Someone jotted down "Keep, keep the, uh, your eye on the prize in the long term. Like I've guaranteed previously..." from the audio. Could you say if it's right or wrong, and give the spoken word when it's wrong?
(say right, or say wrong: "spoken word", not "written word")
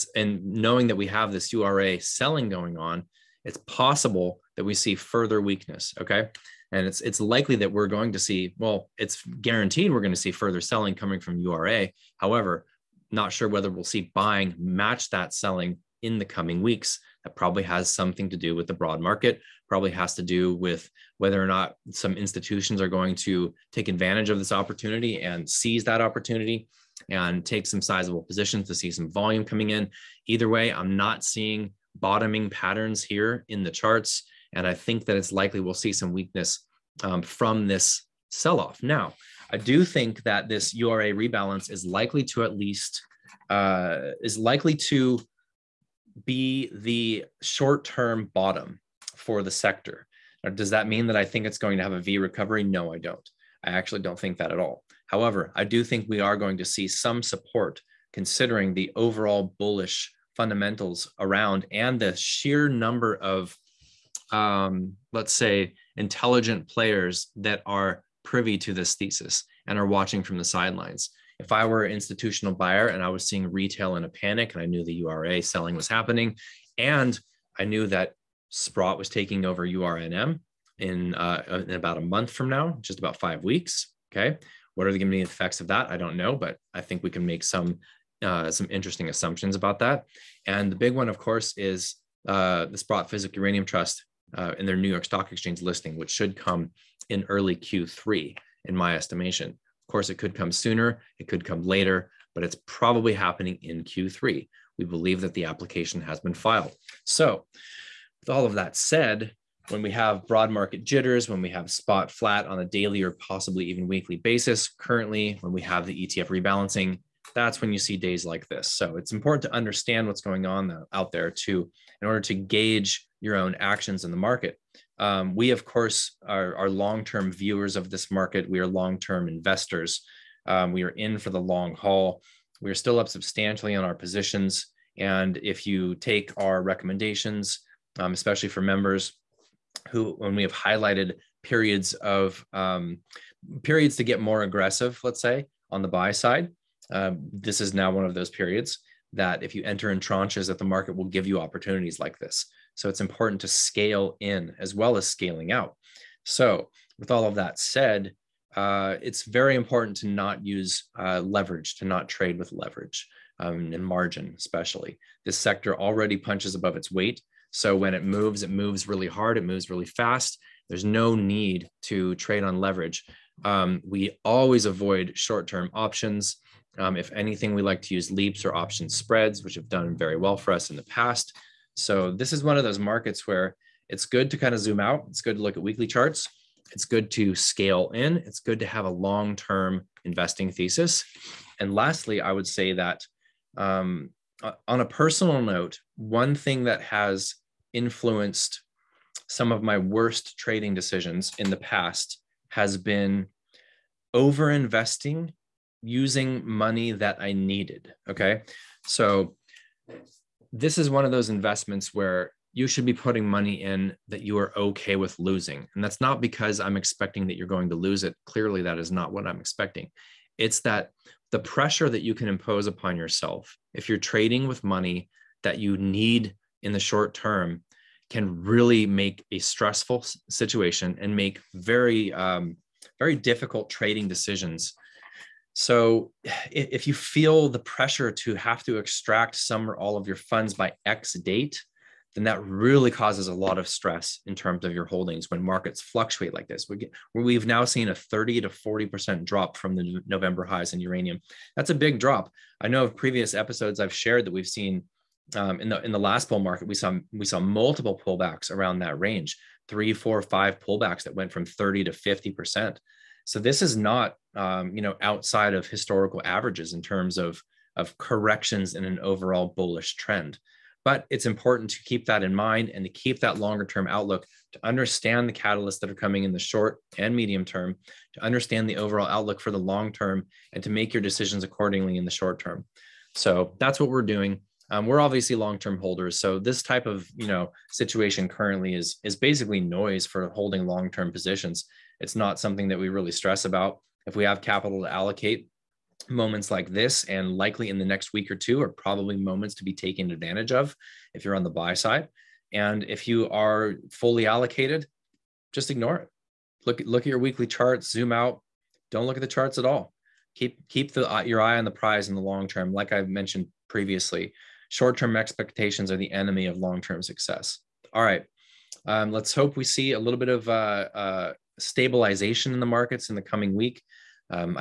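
wrong: "mentioned", not "guaranteed".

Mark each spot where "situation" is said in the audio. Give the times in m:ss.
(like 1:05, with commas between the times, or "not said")
3:50, 4:47.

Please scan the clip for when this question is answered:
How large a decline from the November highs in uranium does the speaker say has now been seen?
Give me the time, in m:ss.
4:07.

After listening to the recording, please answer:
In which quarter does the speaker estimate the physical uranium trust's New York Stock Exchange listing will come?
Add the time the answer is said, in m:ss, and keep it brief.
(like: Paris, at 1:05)
Q3, at 1:37.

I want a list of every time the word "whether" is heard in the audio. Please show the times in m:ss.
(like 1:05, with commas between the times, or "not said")
0:13, 0:21.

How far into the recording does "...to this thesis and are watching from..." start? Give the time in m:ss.
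1:08.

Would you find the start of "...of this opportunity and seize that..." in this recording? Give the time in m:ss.
0:24.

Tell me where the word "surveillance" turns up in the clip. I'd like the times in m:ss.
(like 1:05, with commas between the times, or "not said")
not said.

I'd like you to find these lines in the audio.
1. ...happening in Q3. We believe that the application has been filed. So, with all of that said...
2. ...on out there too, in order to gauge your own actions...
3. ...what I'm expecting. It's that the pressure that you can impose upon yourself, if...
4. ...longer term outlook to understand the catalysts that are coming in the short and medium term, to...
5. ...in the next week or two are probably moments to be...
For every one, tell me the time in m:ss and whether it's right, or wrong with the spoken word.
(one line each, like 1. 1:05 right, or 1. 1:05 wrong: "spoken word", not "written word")
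1. 1:43 right
2. 2:00 right
3. 3:39 right
4. 4:33 right
5. 4:57 right.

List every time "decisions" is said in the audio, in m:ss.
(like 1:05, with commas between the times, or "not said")
3:20, 3:54, 4:41.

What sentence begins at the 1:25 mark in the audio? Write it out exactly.
I don't know, but I think we can make some uh, some interesting assumptions about that.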